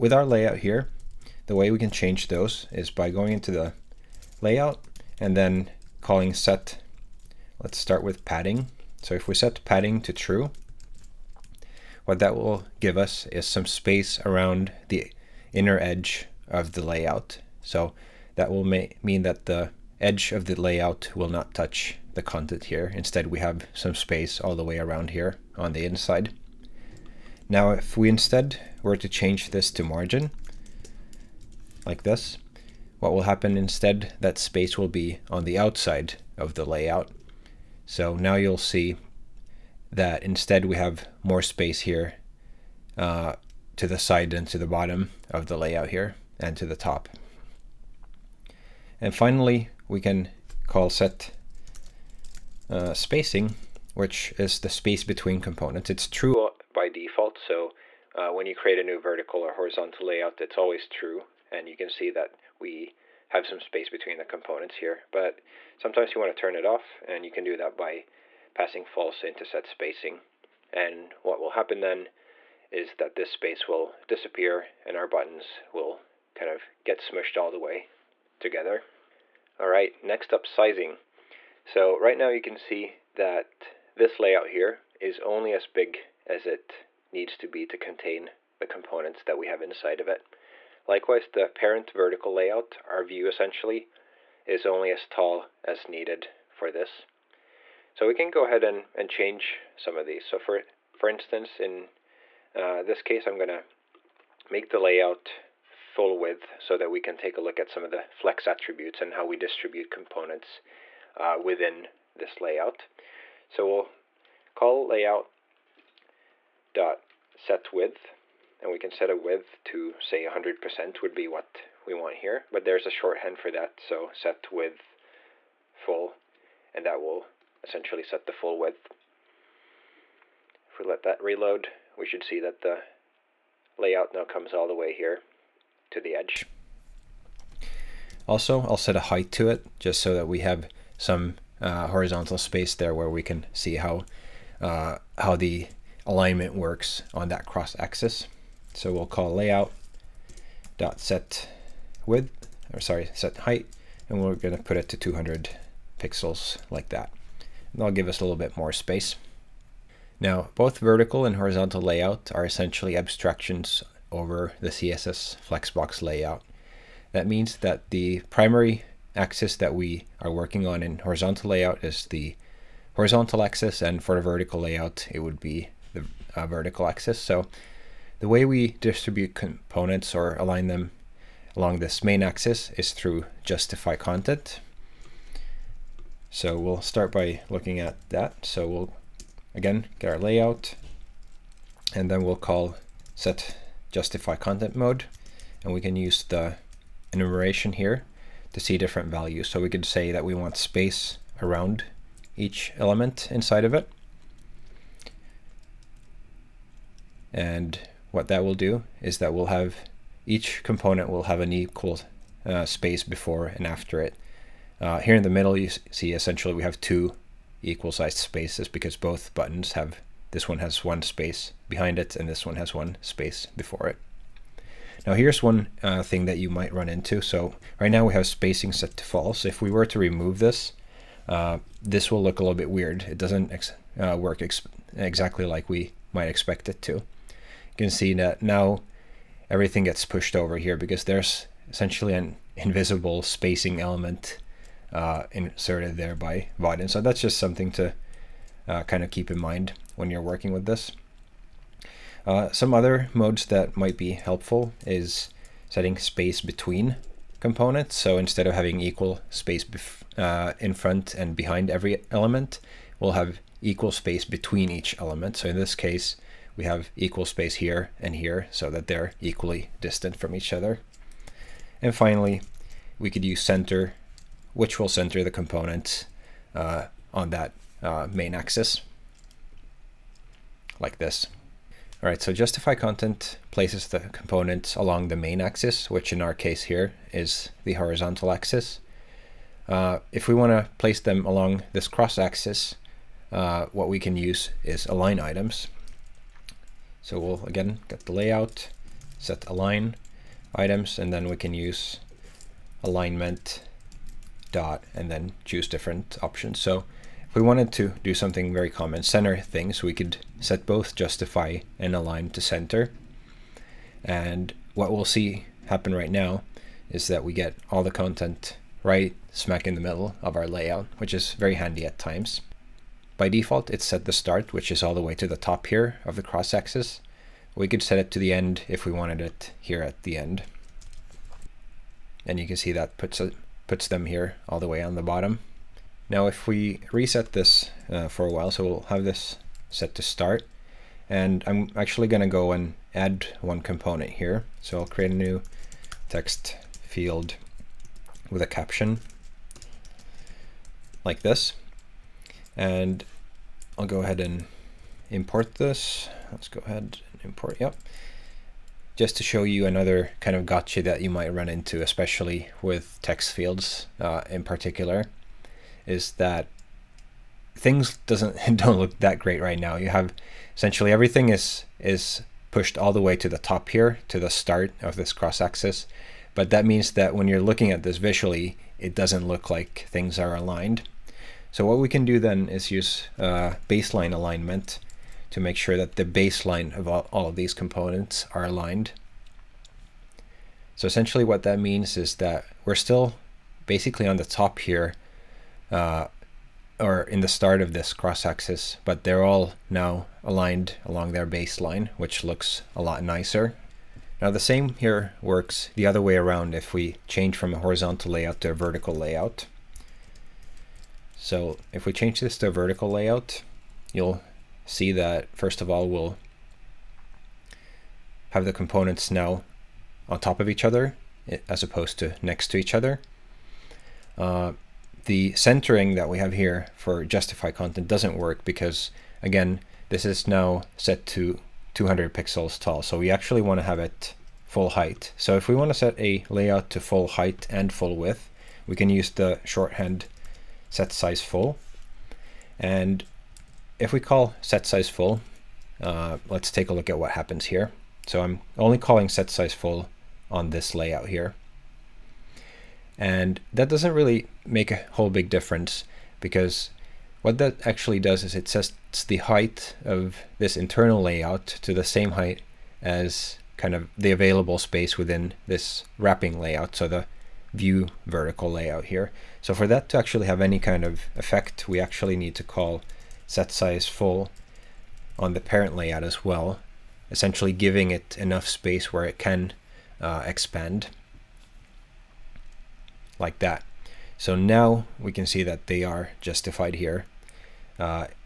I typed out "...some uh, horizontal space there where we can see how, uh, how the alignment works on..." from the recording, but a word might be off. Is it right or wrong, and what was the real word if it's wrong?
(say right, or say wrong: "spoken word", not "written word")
right.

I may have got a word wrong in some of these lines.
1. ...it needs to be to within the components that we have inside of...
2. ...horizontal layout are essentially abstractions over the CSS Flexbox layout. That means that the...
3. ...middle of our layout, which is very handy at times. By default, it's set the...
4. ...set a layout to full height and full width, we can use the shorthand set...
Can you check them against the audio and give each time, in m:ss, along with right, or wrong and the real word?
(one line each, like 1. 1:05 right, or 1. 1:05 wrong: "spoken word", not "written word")
1. 1:26 wrong: "contain", not "within"
2. 2:41 right
3. 5:19 right
4. 7:15 right.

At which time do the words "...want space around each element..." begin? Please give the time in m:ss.
3:20.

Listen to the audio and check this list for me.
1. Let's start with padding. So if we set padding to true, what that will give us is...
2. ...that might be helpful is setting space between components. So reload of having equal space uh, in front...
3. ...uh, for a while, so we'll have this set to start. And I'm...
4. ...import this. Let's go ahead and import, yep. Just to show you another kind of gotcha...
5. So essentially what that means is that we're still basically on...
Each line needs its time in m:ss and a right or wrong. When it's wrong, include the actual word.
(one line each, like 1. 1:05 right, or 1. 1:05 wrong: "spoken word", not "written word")
1. 0:07 right
2. 4:13 wrong: "instead", not "reload"
3. 5:37 right
4. 5:55 right
5. 6:30 right.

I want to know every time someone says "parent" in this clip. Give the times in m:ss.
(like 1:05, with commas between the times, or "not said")
1:31, 7:55.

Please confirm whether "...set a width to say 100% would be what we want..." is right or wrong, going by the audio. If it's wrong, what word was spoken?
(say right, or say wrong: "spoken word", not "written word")
right.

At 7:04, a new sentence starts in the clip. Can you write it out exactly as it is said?
Uh, the centering that we have here for justify content doesn't work because again, this is now set to 200 pixels tall.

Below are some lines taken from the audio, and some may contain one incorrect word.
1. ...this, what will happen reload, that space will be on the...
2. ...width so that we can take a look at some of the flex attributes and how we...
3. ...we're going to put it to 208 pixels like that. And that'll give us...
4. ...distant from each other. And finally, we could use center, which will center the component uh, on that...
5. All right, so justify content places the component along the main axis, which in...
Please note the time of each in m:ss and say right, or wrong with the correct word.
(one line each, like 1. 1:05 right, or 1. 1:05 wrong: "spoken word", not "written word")
1. 0:32 wrong: "instead", not "reload"
2. 1:46 right
3. 2:34 wrong: "200", not "208"
4. 4:29 right
5. 4:42 right.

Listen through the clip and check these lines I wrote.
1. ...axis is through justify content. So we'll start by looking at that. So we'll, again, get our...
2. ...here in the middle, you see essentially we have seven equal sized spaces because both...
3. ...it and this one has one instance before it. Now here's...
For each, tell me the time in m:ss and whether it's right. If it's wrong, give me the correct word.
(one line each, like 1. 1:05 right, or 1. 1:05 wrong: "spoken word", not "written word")
1. 3:02 right
2. 3:34 wrong: "two", not "seven"
3. 3:41 wrong: "space", not "instance".